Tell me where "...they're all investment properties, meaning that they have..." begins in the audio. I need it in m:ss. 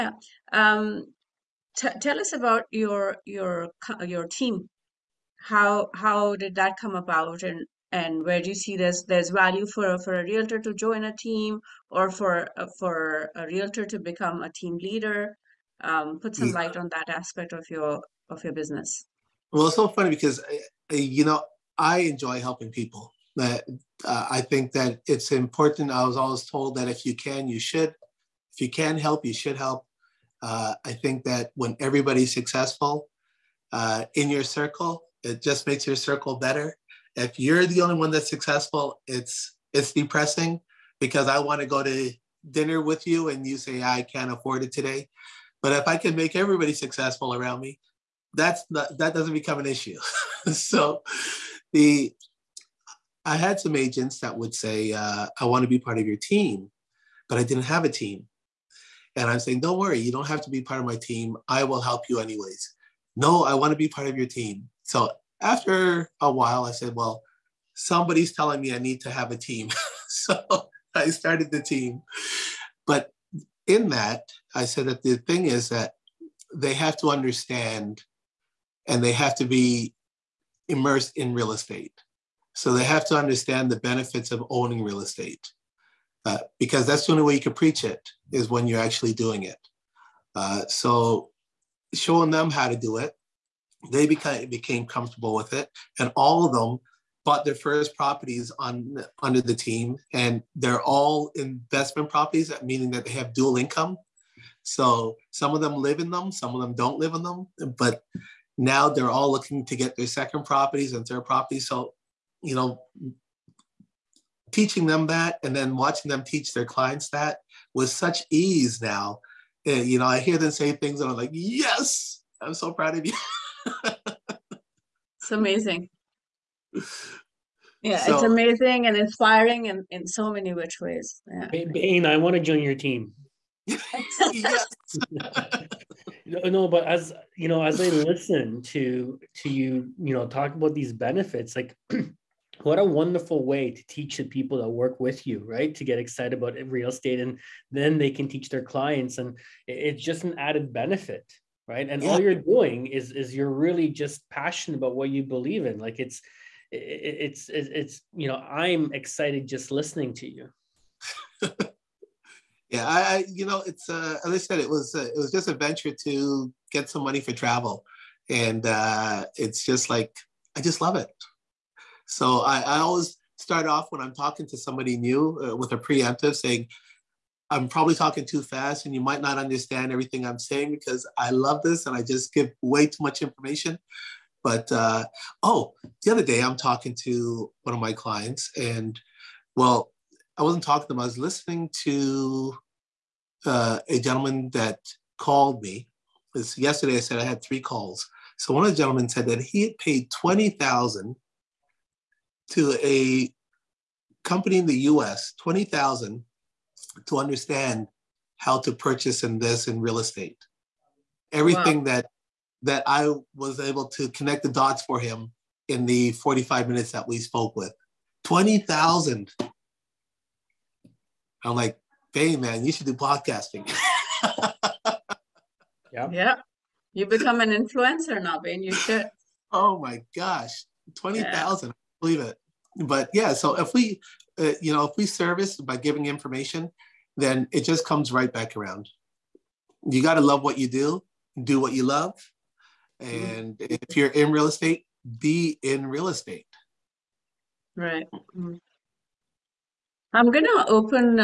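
1:40.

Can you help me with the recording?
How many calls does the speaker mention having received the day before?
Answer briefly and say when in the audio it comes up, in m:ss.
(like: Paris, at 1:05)
3, at 3:17.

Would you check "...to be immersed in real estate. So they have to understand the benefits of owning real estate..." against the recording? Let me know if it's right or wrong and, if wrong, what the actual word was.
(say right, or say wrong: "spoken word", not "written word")
right.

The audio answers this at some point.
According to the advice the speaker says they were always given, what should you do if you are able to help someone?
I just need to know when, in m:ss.
0:28.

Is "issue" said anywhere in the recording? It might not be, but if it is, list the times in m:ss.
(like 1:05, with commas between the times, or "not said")
0:49.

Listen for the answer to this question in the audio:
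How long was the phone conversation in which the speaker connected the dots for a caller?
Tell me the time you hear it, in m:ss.
3:36.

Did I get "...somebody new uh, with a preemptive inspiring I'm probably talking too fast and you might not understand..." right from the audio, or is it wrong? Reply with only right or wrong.
wrong.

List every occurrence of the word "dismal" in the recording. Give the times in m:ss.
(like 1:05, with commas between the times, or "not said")
not said.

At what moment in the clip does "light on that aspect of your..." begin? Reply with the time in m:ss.
0:16.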